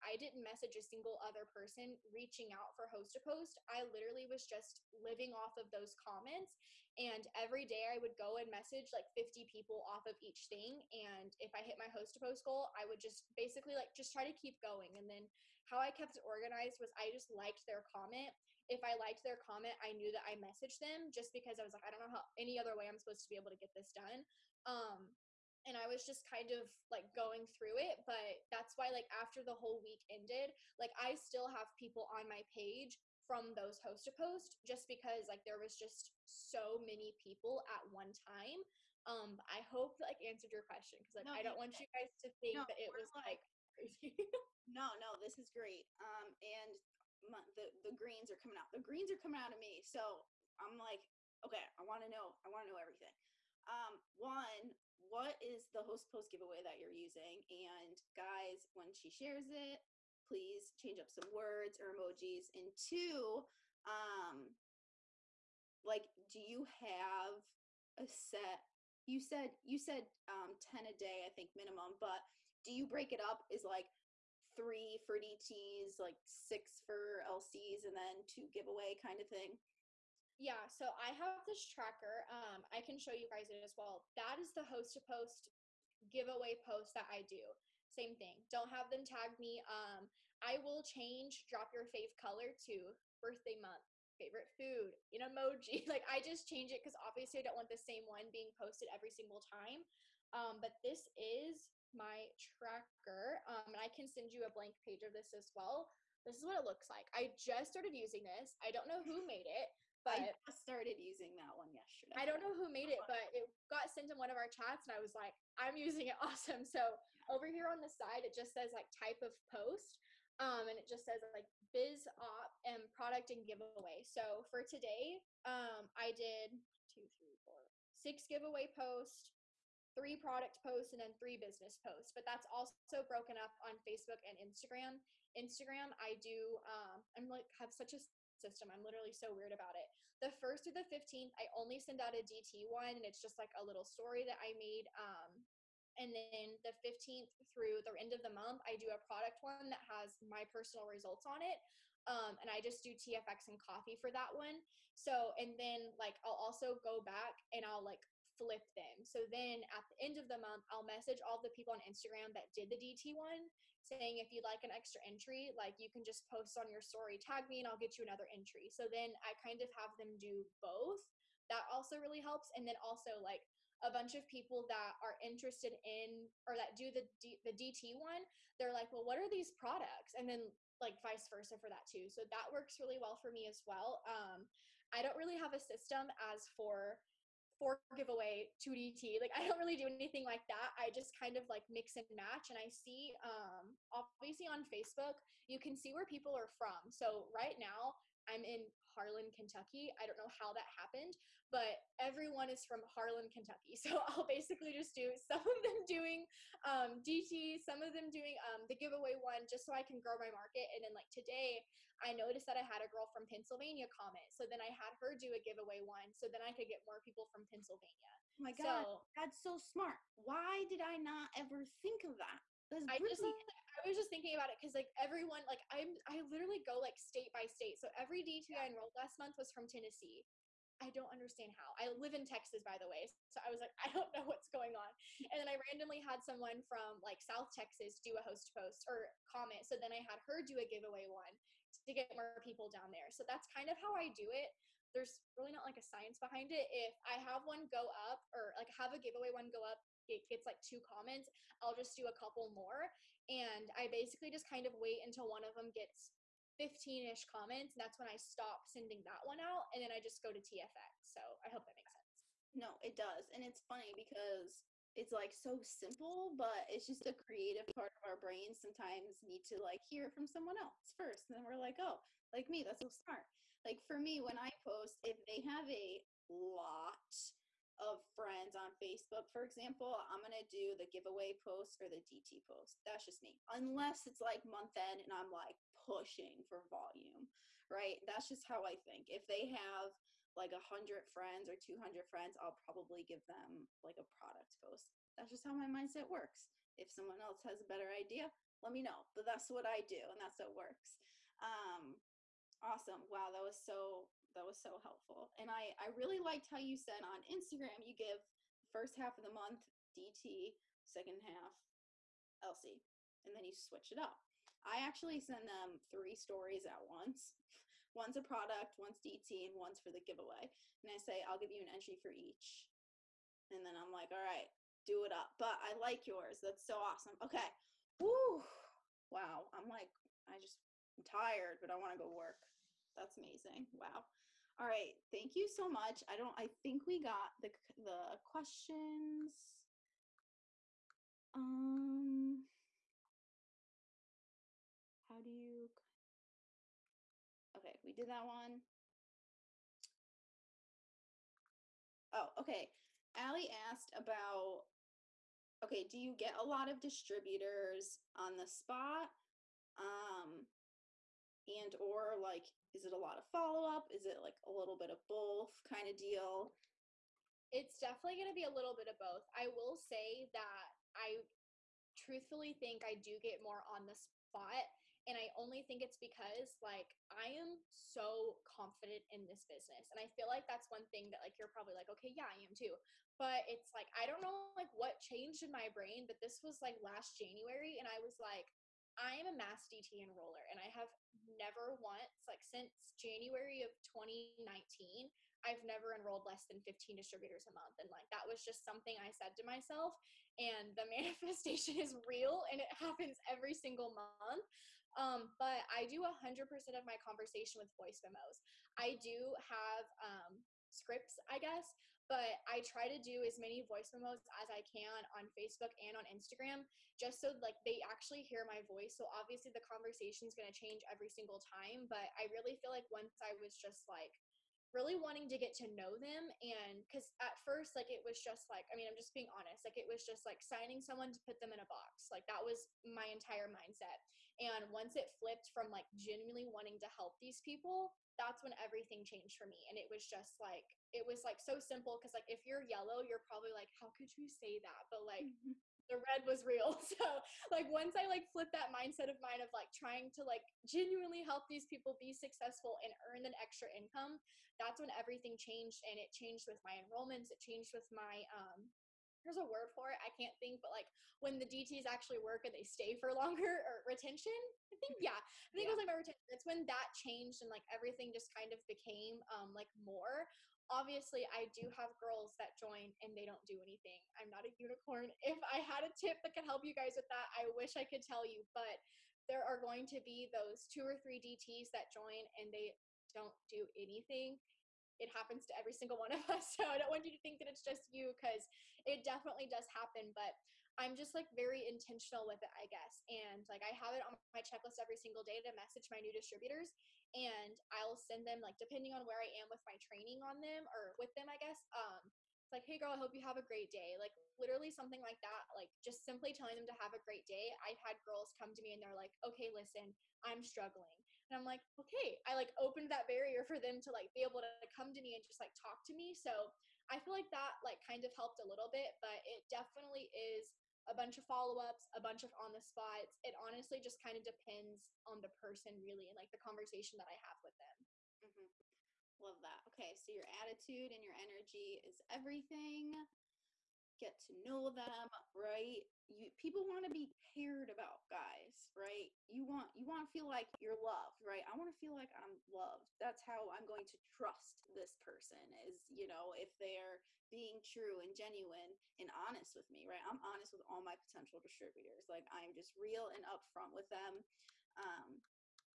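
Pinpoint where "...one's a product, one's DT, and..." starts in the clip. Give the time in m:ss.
5:17.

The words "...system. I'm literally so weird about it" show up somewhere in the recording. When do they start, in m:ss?
2:18.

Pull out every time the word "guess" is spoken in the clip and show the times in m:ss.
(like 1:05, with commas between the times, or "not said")
6:51, 8:12, 8:21.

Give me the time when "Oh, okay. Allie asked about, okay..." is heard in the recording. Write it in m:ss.
5:52.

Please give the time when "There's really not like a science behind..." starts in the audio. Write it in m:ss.
4:04.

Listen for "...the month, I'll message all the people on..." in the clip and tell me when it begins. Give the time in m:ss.
2:40.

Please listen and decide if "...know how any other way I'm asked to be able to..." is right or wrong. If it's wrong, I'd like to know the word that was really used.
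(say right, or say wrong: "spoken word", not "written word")
wrong: "supposed", not "asked".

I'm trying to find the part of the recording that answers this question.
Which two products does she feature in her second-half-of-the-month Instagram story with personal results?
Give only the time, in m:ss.
2:32.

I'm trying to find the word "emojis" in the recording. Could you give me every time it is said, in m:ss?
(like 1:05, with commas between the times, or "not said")
1:01, 1:35.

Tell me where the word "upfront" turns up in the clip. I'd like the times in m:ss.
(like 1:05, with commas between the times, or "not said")
9:13.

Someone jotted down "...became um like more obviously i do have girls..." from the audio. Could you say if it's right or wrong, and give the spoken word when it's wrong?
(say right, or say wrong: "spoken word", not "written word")
right.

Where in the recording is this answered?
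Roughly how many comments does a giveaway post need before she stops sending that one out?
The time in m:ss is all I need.
4:16.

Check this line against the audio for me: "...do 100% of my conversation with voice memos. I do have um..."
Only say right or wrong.
right.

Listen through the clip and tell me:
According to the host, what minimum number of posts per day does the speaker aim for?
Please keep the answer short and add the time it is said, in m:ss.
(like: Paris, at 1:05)
10, at 1:10.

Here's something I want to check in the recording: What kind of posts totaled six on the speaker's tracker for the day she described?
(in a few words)
Giveaway posts.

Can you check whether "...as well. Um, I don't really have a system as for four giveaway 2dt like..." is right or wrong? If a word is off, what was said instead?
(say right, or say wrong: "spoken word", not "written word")
right.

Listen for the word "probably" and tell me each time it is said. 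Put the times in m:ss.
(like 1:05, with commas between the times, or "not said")
4:52, 6:21, 7:23.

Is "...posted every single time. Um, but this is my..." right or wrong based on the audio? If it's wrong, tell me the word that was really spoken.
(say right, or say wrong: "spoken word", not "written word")
right.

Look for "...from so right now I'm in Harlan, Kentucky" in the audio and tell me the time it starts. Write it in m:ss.
3:16.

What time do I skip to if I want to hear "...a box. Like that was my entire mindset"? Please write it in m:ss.
7:11.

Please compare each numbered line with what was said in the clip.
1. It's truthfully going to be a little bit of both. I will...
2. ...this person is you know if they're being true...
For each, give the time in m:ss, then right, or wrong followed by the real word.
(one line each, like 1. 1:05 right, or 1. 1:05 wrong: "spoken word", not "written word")
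1. 6:07 wrong: "definitely", not "truthfully"
2. 9:04 right.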